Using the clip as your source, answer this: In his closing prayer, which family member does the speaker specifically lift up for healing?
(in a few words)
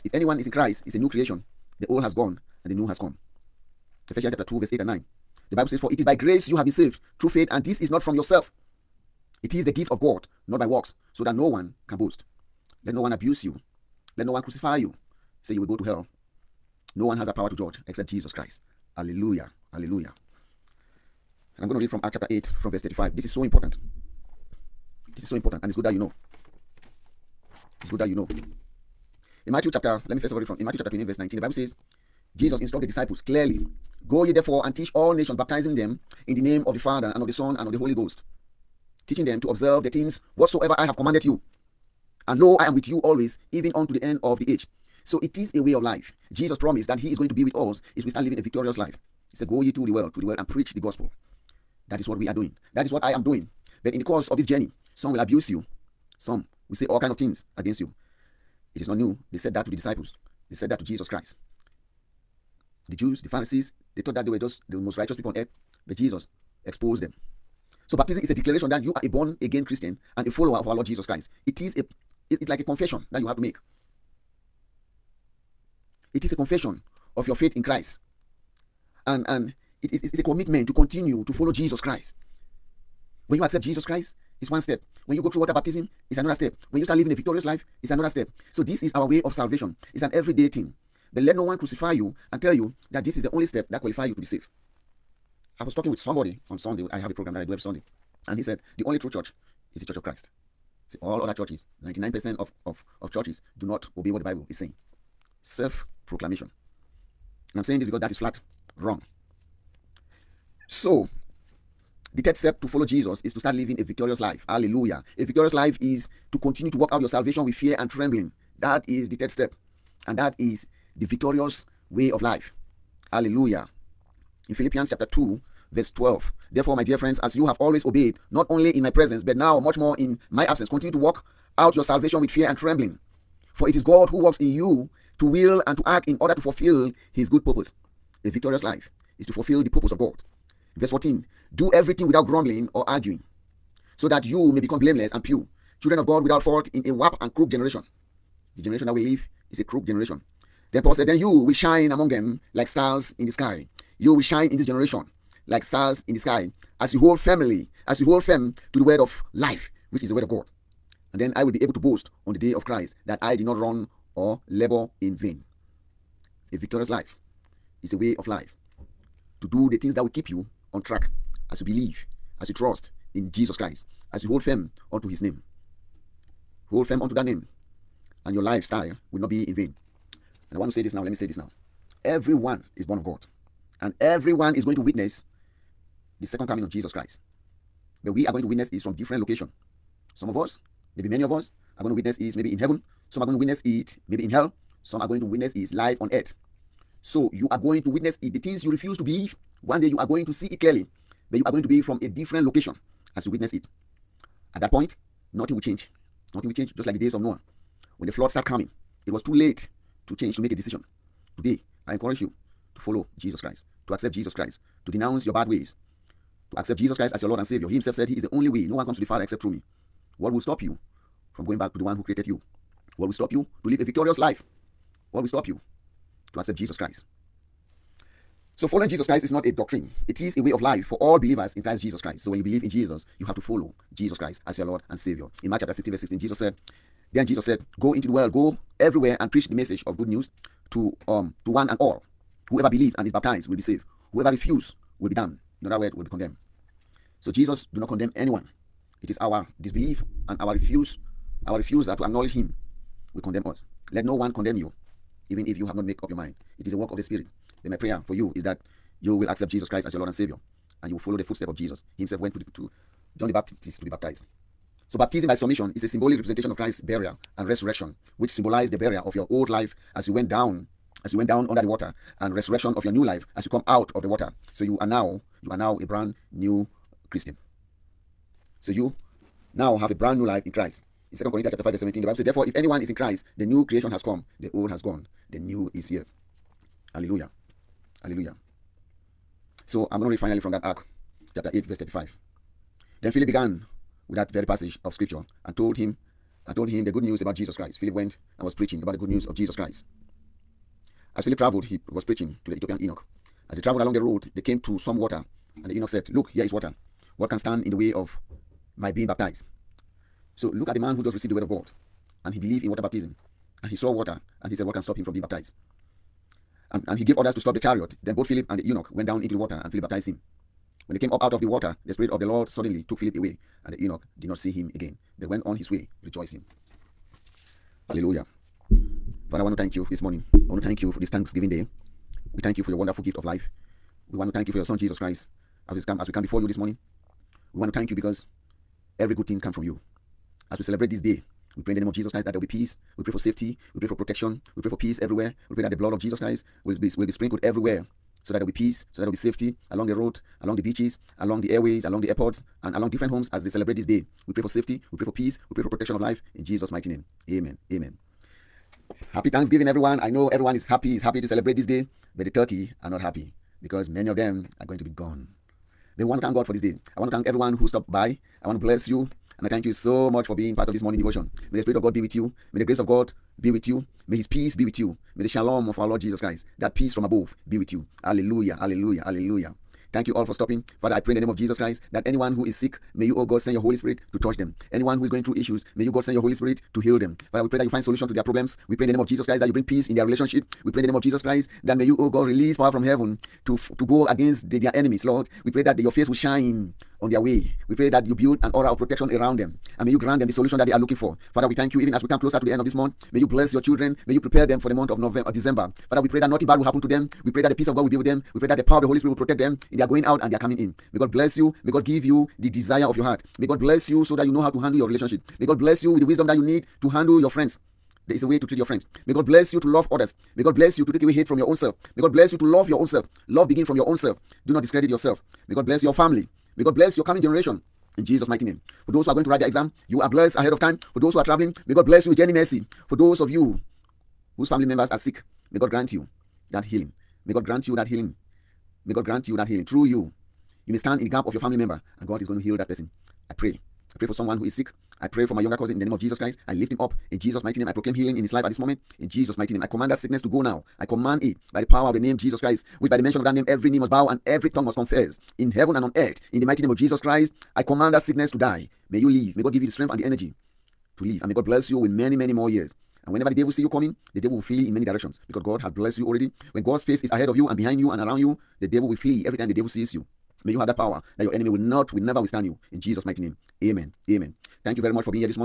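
Younger cousin.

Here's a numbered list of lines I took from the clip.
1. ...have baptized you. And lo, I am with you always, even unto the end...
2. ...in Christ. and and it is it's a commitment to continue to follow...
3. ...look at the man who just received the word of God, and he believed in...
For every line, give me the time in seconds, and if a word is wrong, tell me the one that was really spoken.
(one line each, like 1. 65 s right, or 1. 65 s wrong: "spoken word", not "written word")
1. 40 s wrong: "commanded", not "baptized"
2. 77 s right
3. 310 s right.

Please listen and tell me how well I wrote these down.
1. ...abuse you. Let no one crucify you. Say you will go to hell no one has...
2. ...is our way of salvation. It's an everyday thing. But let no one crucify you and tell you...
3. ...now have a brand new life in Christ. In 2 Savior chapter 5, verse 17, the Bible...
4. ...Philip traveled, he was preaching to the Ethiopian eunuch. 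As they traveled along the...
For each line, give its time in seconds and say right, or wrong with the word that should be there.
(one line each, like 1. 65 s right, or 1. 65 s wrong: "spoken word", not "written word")
1. 13 s right
2. 88 s right
3. 279 s wrong: "Corinthians", not "Savior"
4. 301 s right.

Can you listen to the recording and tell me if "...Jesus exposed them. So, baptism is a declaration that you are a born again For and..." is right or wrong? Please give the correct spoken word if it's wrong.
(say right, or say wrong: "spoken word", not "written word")
wrong: "Christian", not "For".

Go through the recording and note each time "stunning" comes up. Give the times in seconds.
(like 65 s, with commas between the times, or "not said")
not said.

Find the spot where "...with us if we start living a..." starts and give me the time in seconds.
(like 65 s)
47 s.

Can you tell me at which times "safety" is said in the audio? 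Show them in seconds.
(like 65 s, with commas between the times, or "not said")
343 s, 349 s, 354 s.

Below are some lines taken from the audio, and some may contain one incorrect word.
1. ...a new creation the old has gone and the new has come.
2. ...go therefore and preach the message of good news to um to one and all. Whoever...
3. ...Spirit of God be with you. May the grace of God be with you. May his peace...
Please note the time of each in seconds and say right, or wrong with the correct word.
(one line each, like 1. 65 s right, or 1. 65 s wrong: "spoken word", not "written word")
1. 0 s right
2. 238 s wrong: "everywhere", not "therefore"
3. 371 s right.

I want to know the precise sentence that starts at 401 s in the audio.
Father, we thank you even as we come closer to the end of this month.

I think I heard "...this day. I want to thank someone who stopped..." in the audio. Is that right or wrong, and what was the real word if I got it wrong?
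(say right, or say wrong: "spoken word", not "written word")
wrong: "everyone", not "someone".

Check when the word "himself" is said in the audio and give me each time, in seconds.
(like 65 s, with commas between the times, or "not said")
217 s, 262 s.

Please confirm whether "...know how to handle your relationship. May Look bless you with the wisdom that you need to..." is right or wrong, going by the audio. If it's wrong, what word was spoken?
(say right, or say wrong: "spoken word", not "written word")
wrong: "God", not "Look".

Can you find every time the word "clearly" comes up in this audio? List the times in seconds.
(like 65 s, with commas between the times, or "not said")
33 s, 200 s.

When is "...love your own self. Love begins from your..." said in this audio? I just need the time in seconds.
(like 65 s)
422 s.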